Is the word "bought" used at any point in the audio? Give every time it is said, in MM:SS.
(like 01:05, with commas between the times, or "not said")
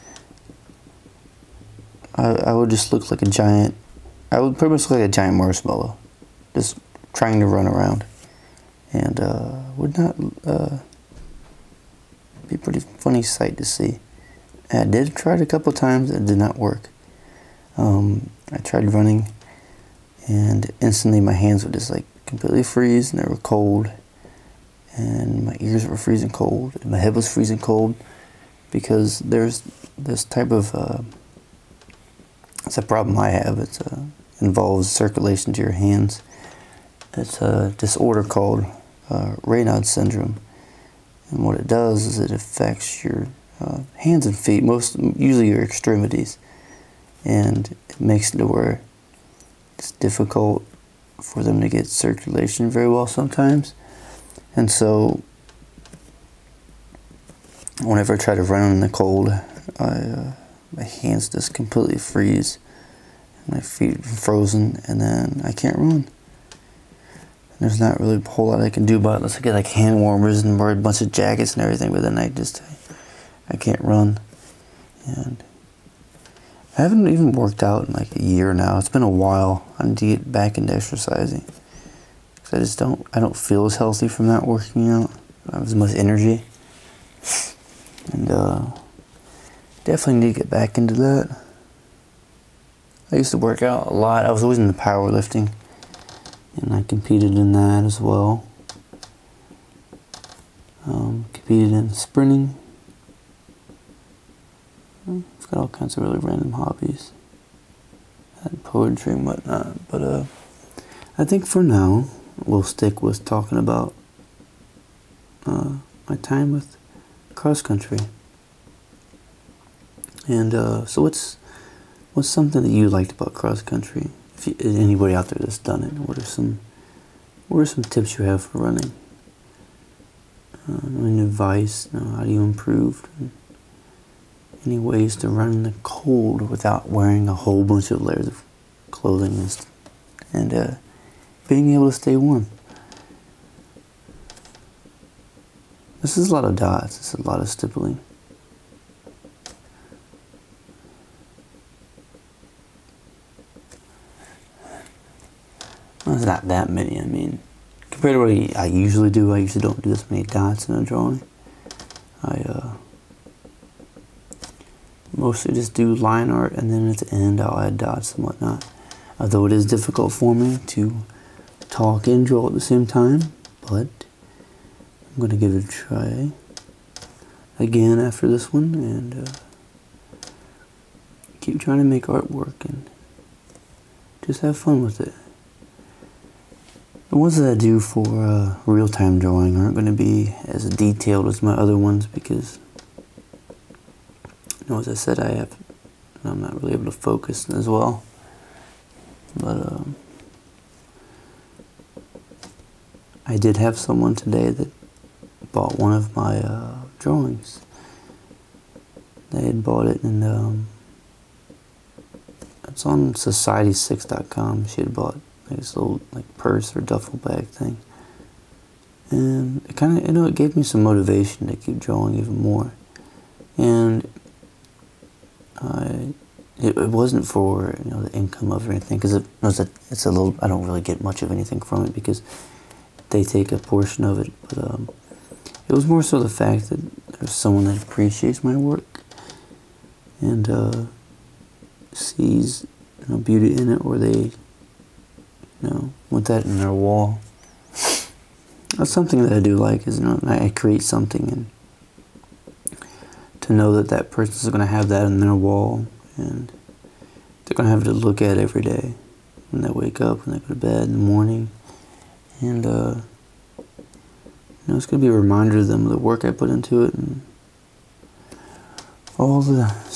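03:25, 03:29, 03:34.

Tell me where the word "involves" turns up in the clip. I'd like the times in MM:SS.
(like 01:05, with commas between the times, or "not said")
00:34.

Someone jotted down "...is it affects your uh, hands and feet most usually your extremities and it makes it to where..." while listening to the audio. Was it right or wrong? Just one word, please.
right.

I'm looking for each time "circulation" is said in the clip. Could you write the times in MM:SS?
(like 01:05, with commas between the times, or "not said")
00:34, 00:51.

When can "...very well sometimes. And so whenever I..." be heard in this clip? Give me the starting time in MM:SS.
00:52.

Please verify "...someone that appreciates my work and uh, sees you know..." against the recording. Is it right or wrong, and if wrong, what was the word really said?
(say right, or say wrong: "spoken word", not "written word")
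right.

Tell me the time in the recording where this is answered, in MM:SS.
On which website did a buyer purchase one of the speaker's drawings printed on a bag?
03:33.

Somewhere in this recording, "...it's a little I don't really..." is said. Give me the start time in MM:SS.
03:49.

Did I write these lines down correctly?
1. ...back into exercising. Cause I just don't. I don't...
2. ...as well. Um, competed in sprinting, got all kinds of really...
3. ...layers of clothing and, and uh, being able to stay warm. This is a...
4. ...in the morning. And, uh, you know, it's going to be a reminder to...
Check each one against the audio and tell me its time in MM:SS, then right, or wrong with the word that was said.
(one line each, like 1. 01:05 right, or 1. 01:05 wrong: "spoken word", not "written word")
1. 01:20 right
2. 01:37 right
3. 02:17 right
4. 04:20 right.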